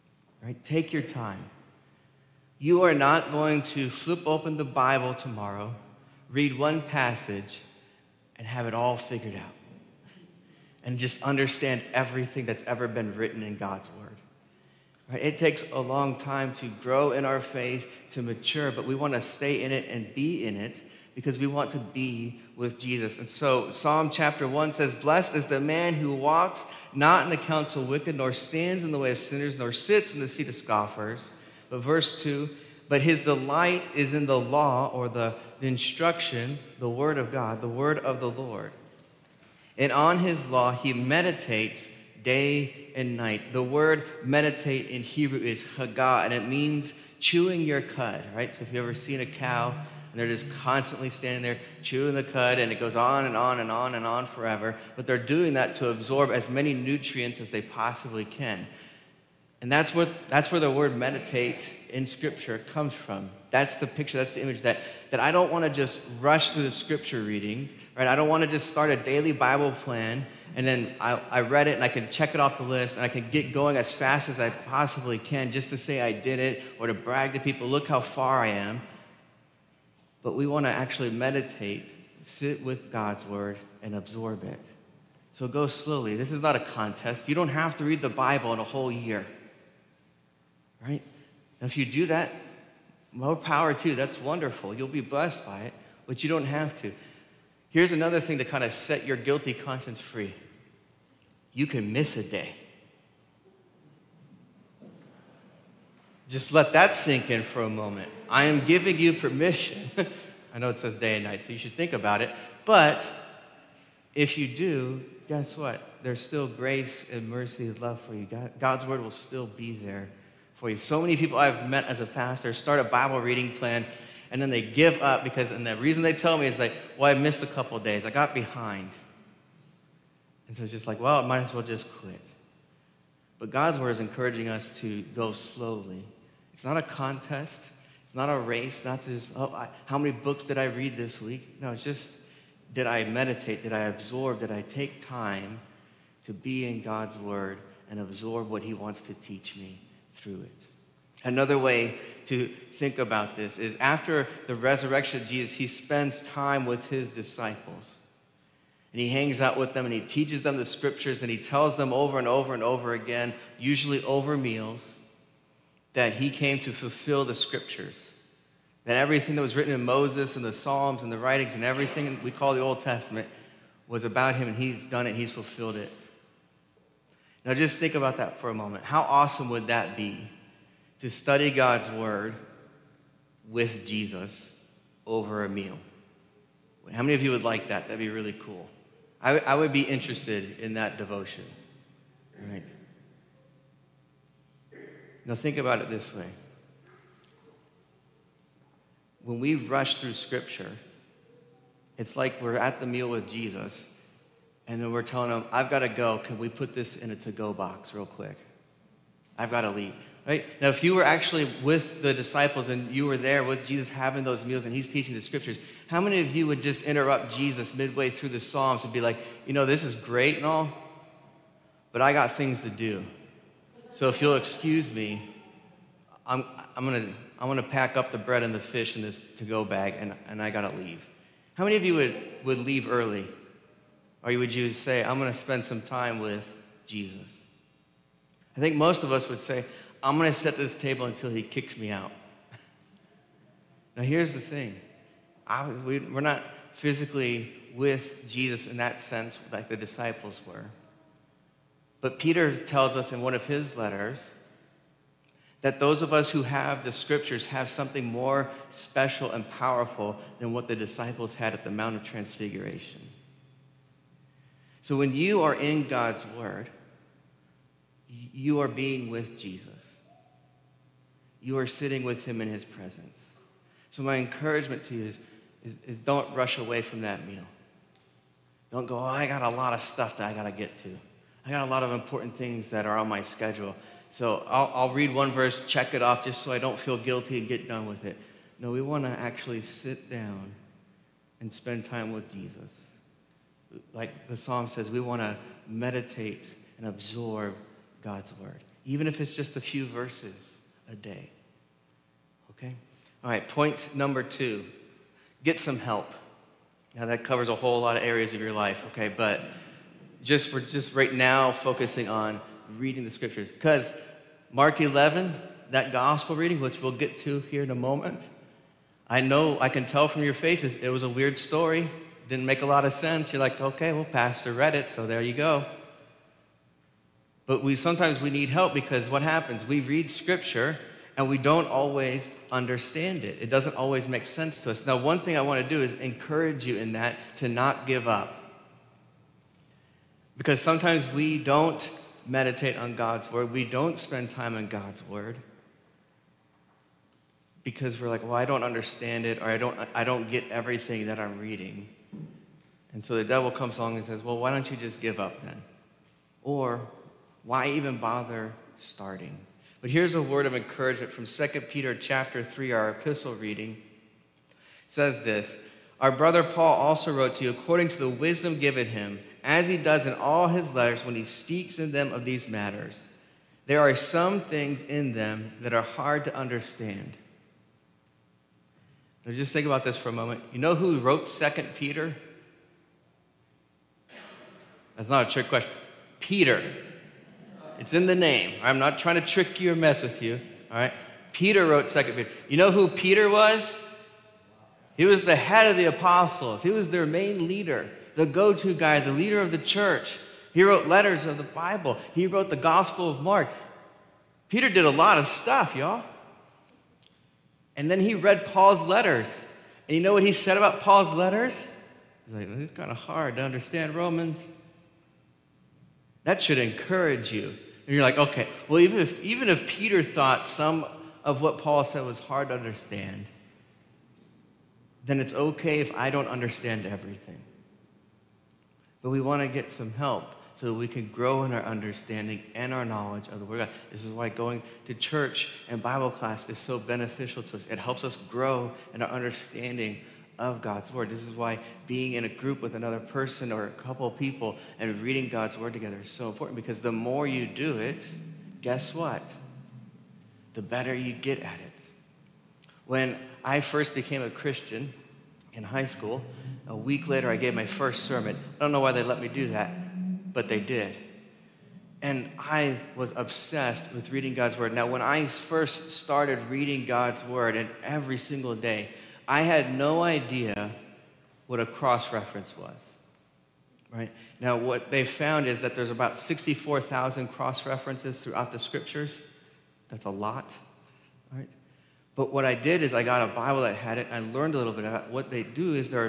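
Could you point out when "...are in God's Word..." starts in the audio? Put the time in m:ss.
4:25.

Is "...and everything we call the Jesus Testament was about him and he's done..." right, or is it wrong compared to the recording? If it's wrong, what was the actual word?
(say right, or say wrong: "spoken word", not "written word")
wrong: "Old", not "Jesus".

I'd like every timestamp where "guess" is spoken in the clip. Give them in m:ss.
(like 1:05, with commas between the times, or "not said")
1:55, 7:28.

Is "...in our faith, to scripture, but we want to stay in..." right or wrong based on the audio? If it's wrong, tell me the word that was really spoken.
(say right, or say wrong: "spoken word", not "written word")
wrong: "mature", not "scripture".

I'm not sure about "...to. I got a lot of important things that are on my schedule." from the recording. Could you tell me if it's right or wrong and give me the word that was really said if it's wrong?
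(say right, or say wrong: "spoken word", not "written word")
right.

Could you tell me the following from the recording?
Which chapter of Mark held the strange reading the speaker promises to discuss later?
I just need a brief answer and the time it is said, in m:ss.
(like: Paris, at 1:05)
Mark 11, at 5:14.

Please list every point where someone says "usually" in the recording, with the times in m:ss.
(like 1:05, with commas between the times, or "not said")
2:43.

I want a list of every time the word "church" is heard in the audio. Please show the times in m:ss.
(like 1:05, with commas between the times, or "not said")
6:39, 7:14.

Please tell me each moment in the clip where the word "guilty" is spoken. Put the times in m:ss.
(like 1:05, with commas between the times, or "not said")
1:39, 4:46.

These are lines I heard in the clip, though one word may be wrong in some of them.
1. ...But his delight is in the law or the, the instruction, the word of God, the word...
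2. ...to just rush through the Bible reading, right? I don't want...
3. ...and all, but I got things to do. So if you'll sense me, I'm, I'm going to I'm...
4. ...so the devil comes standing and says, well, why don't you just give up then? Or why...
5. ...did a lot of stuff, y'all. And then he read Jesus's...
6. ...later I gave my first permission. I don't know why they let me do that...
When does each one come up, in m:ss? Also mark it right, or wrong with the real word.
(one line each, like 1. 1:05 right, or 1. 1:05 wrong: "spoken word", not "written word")
1. 0:32 right
2. 1:05 wrong: "Scripture", not "Bible"
3. 3:40 wrong: "excuse", not "sense"
4. 5:53 wrong: "along", not "standing"
5. 6:44 wrong: "Paul", not "Jesus"
6. 7:37 wrong: "sermon", not "permission".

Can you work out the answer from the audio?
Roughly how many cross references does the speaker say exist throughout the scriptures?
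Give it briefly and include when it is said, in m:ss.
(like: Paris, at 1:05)
64,000, at 7:56.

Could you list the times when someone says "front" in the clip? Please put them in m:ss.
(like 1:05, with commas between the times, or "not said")
not said.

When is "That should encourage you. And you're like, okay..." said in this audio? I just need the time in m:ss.
6:56.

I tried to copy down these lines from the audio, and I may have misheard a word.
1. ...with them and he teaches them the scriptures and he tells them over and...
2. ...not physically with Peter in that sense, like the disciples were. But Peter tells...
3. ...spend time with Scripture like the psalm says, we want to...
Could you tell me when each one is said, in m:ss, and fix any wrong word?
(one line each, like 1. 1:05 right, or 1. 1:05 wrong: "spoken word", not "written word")
1. 2:39 right
2. 4:06 wrong: "Jesus", not "Peter"
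3. 4:51 wrong: "Jesus", not "Scripture".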